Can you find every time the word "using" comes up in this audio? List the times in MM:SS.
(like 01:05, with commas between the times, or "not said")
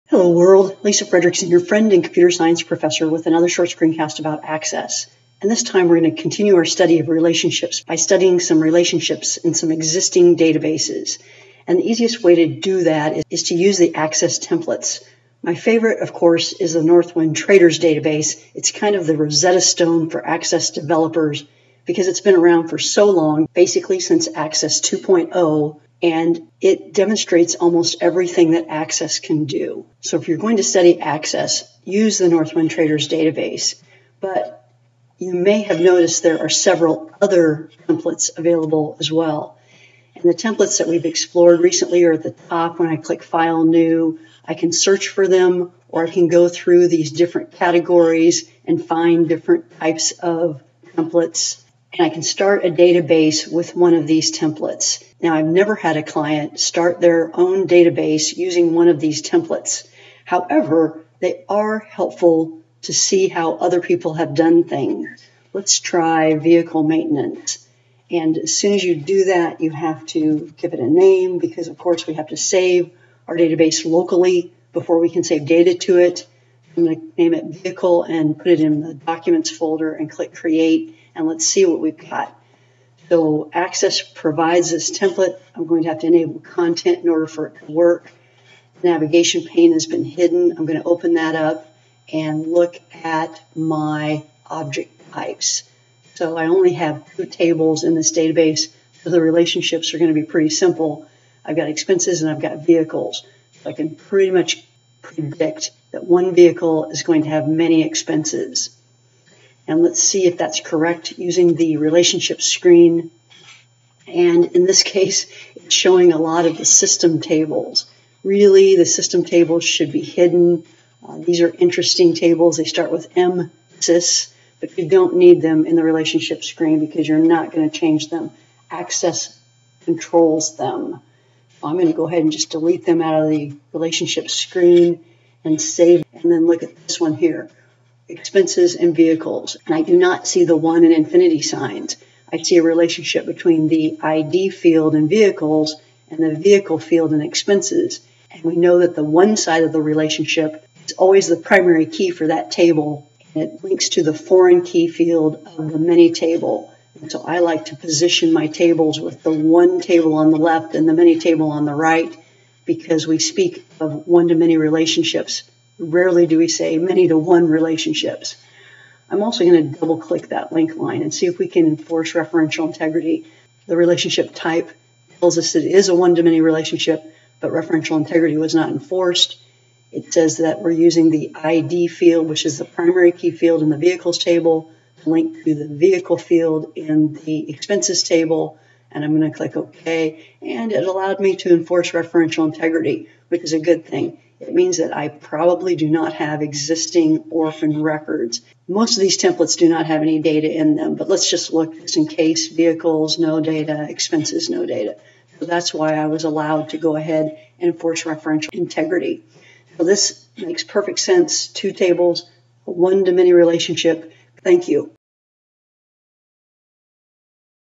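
00:58, 01:51, 03:00.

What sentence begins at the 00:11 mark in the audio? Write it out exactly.
And the easiest way to do that is, is to use the access templates.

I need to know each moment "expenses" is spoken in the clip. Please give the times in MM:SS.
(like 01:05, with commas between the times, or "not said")
01:41, 01:47, 02:18, 02:27, 03:07, 03:23.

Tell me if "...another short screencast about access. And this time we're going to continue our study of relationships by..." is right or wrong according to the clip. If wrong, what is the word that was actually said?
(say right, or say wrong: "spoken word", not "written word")
right.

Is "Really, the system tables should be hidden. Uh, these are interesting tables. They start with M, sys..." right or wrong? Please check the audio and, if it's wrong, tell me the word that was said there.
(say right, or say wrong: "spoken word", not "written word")
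right.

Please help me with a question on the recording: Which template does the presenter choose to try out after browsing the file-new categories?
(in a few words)
vehicle maintenance.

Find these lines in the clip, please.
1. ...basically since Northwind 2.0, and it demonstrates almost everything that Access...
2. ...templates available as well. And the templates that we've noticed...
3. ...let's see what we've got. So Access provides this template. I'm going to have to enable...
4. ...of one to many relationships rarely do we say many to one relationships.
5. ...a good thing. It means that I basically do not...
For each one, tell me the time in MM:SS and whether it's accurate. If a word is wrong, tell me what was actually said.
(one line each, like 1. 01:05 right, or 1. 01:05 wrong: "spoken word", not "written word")
1. 00:23 wrong: "Access", not "Northwind"
2. 00:37 wrong: "explored", not "noticed"
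3. 01:21 right
4. 02:43 right
5. 03:13 wrong: "probably", not "basically".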